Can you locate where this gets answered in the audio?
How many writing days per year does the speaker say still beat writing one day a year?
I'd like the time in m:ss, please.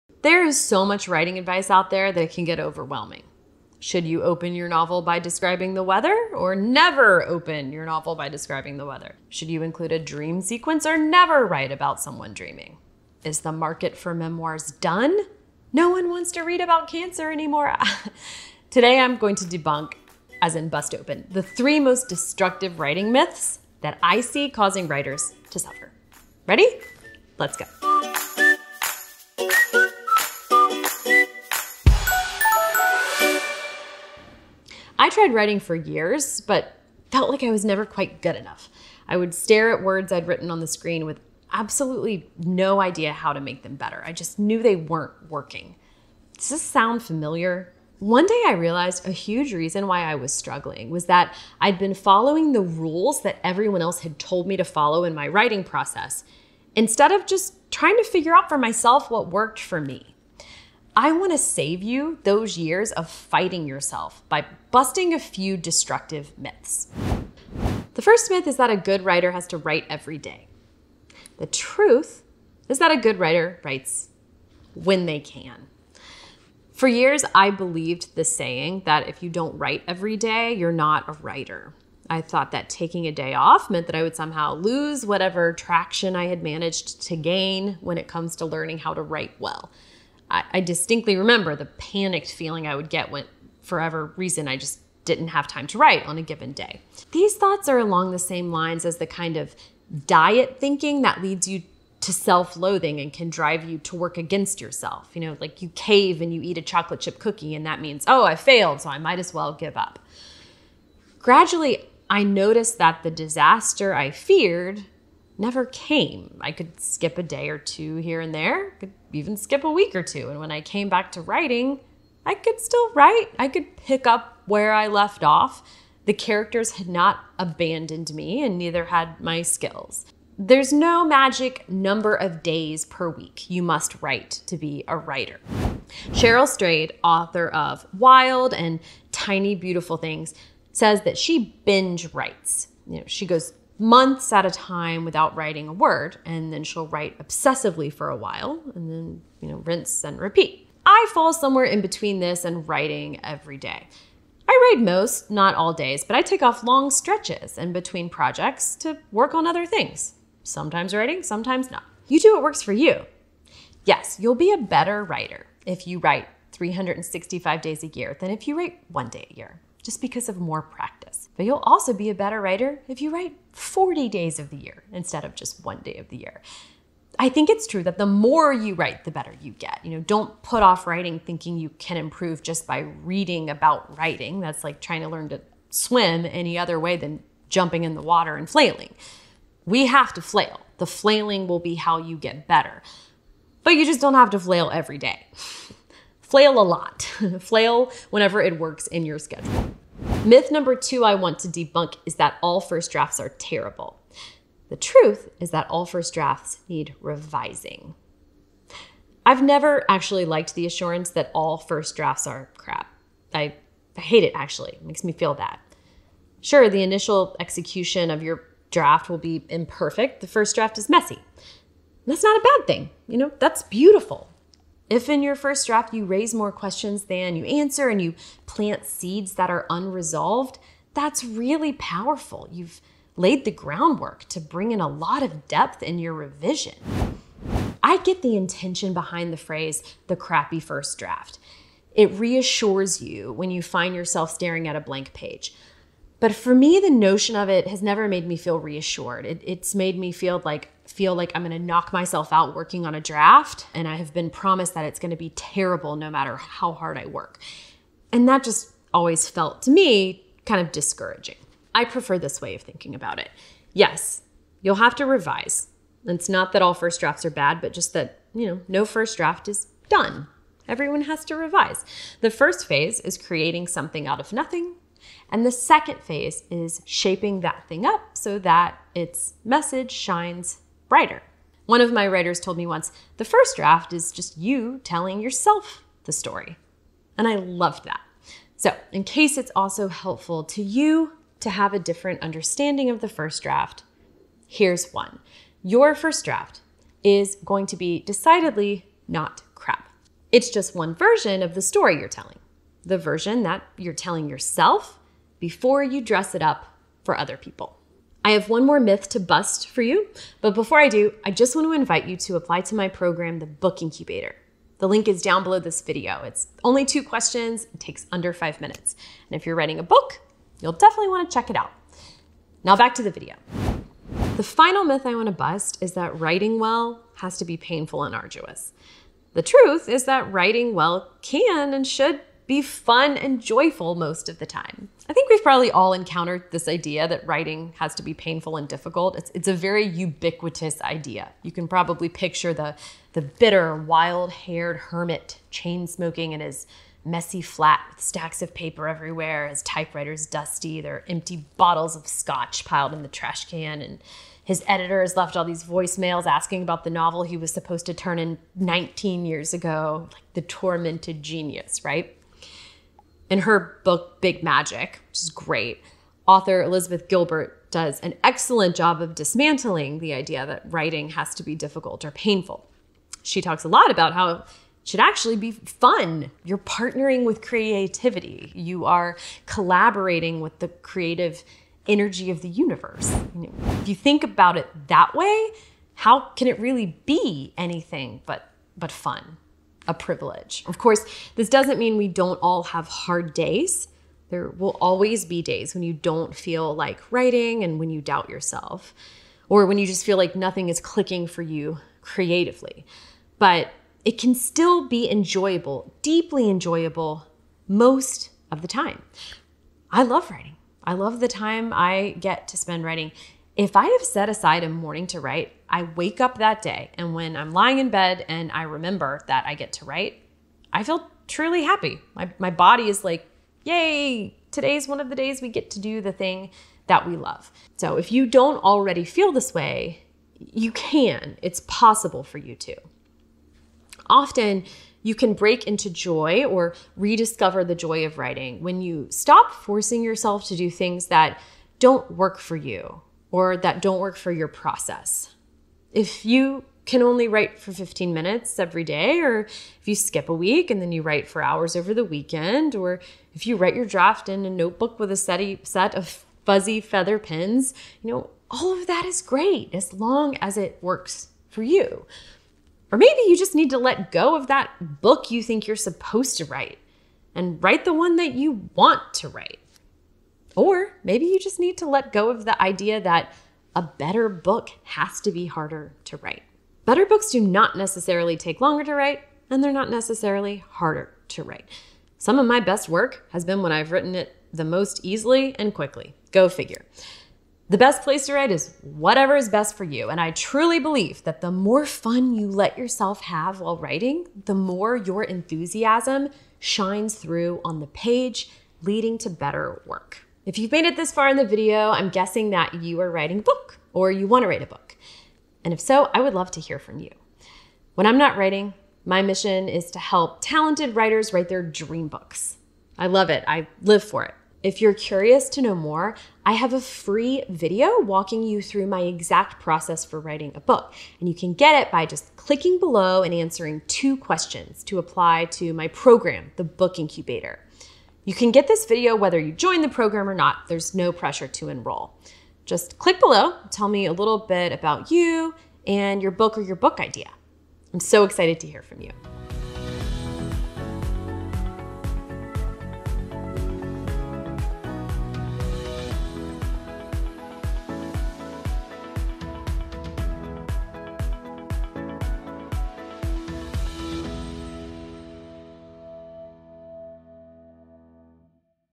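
2:53.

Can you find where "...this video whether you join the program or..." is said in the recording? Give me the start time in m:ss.
8:48.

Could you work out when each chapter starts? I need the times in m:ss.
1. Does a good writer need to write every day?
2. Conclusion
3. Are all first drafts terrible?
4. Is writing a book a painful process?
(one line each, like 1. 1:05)
1. 1:09
2. 8:20
3. 3:21
4. 5:26.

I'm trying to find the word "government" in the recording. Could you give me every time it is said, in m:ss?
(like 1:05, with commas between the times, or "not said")
not said.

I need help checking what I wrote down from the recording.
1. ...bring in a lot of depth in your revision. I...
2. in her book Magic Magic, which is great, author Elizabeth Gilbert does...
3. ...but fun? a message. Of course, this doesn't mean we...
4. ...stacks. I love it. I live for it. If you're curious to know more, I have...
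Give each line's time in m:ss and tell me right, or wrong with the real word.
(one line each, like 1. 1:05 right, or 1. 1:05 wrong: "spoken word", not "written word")
1. 3:54 right
2. 6:03 wrong: "Big", not "Magic"
3. 6:28 wrong: "privilege", not "message"
4. 8:32 wrong: "books", not "stacks".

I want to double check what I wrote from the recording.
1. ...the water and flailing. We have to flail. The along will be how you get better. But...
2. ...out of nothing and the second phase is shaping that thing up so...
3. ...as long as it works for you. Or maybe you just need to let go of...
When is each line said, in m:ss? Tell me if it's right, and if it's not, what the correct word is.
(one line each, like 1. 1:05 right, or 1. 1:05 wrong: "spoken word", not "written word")
1. 3:07 wrong: "flailing", not "along"
2. 4:34 right
3. 7:39 right.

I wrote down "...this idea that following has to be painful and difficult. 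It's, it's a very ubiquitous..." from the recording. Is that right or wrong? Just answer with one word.
wrong.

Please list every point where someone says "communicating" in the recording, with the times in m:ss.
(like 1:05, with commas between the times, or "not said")
not said.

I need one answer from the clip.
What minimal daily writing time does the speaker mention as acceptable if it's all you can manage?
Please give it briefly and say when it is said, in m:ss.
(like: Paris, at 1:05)
15 minutes, at 7:27.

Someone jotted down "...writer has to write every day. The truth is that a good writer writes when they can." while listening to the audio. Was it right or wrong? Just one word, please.
right.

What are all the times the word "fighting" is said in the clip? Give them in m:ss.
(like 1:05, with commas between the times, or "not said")
1:03.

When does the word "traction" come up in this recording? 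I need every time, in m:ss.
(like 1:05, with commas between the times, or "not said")
1:25.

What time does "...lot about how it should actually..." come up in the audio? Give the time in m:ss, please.
6:13.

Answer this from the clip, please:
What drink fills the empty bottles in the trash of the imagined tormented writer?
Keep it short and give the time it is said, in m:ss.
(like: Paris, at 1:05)
scotch, at 5:52.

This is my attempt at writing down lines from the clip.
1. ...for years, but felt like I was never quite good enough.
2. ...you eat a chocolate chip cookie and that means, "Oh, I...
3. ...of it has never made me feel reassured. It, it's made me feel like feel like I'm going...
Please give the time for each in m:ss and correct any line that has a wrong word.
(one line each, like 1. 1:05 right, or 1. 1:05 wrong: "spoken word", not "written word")
1. 0:35 right
2. 1:46 right
3. 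4:07 right.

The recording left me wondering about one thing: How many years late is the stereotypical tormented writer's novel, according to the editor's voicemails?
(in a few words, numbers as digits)
19 years.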